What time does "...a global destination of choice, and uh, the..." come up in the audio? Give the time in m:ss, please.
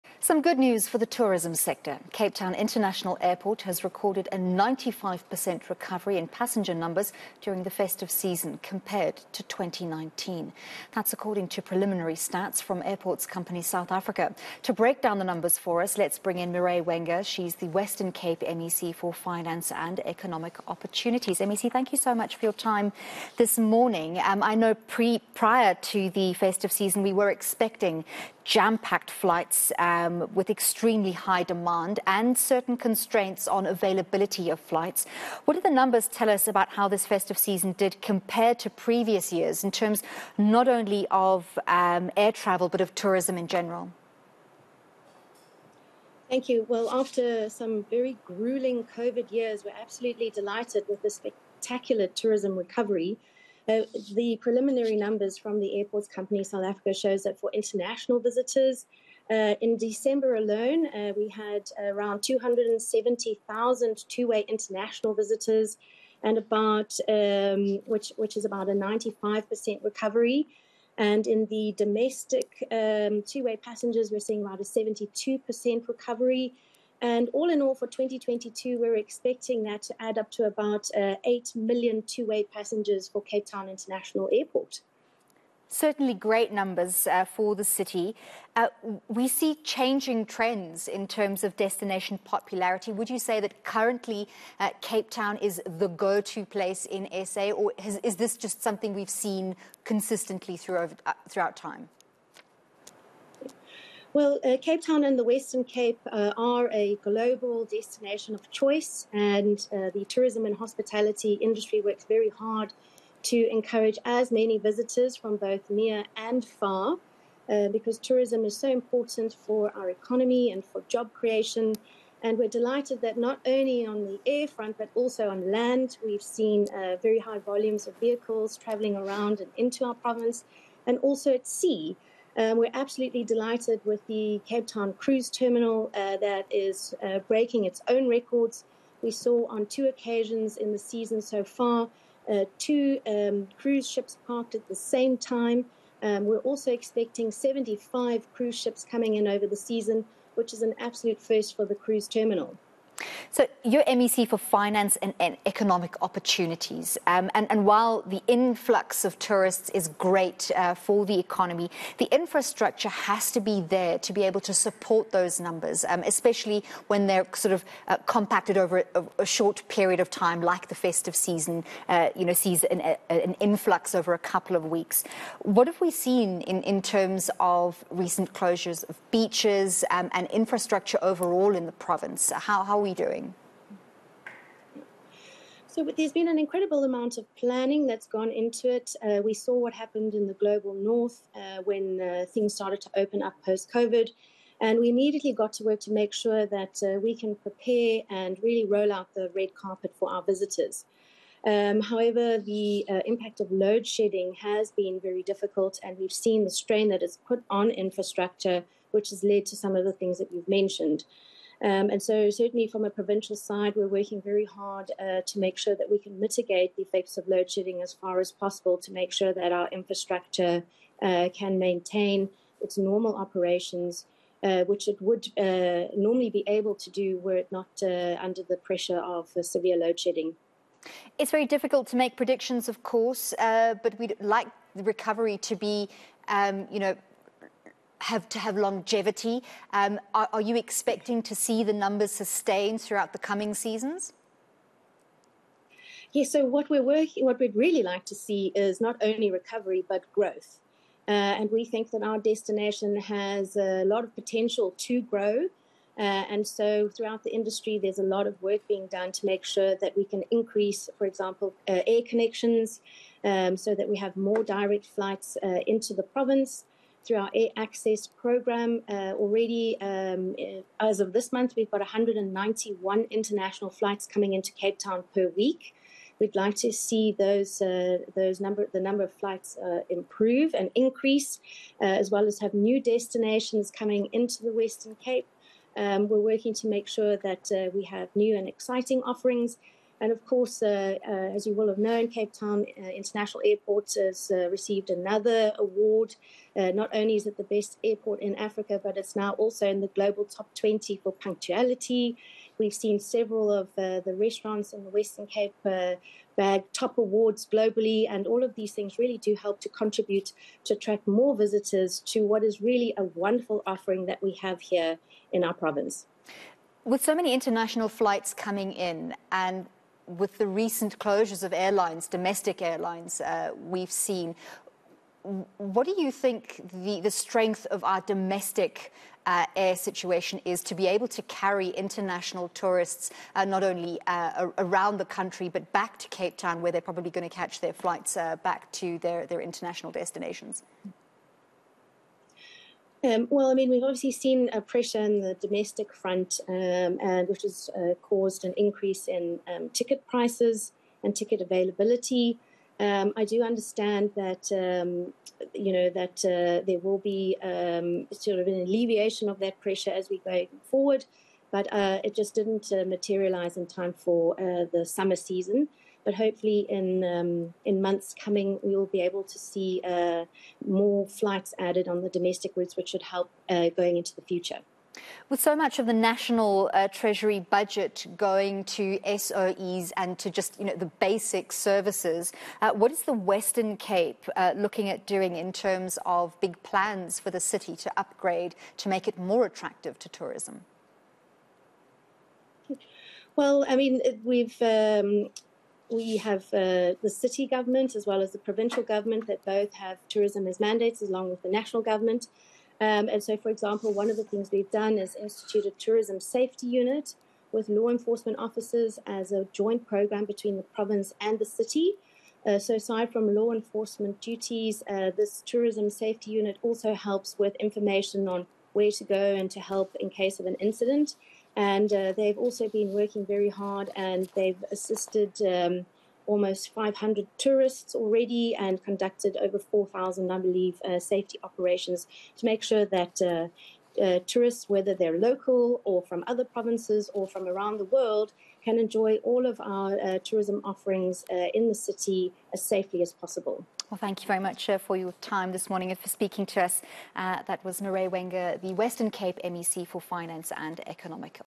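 1:46.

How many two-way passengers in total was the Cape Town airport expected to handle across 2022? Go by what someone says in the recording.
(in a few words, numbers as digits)
8 million.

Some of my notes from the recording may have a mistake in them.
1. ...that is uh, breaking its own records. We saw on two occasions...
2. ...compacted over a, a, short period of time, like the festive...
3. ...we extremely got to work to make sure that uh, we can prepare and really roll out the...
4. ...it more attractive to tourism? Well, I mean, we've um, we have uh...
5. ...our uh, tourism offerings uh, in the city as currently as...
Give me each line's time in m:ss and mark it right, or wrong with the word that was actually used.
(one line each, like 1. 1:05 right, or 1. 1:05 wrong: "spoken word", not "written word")
1. 2:16 right
2. 2:48 right
3. 3:14 wrong: "immediately", not "extremely"
4. 6:29 right
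5. 7:19 wrong: "safely", not "currently".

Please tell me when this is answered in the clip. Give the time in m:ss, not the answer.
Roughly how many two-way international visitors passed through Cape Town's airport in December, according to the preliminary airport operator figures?
1:02.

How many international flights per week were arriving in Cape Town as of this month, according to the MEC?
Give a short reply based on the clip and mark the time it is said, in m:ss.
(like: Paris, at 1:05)
191, at 4:31.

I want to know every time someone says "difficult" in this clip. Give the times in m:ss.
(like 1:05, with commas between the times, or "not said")
3:25, 3:51.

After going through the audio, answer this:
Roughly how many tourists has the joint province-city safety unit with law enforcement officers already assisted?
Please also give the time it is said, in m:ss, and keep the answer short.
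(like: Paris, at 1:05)
500, at 7:06.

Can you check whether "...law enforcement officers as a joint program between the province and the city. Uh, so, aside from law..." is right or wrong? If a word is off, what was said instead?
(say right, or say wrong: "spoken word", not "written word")
right.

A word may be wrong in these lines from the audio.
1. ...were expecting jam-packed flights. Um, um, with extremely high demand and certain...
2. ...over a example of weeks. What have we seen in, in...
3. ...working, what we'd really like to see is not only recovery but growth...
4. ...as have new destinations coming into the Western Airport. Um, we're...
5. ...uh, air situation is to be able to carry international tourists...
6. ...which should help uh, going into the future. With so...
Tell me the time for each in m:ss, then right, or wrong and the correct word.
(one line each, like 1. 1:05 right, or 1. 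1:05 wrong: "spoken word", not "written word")
1. 0:27 right
2. 2:53 wrong: "couple", not "example"
3. 4:06 right
4. 4:42 wrong: "Cape", not "Airport"
5. 5:29 right
6. 6:12 right.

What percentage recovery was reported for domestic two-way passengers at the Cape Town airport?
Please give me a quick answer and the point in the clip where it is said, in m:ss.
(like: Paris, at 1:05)
72%, at 1:14.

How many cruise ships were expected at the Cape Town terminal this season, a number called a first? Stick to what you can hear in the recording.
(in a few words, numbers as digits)
75.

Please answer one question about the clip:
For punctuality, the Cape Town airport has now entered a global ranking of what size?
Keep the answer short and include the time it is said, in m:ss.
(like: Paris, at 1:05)
top 20, at 5:00.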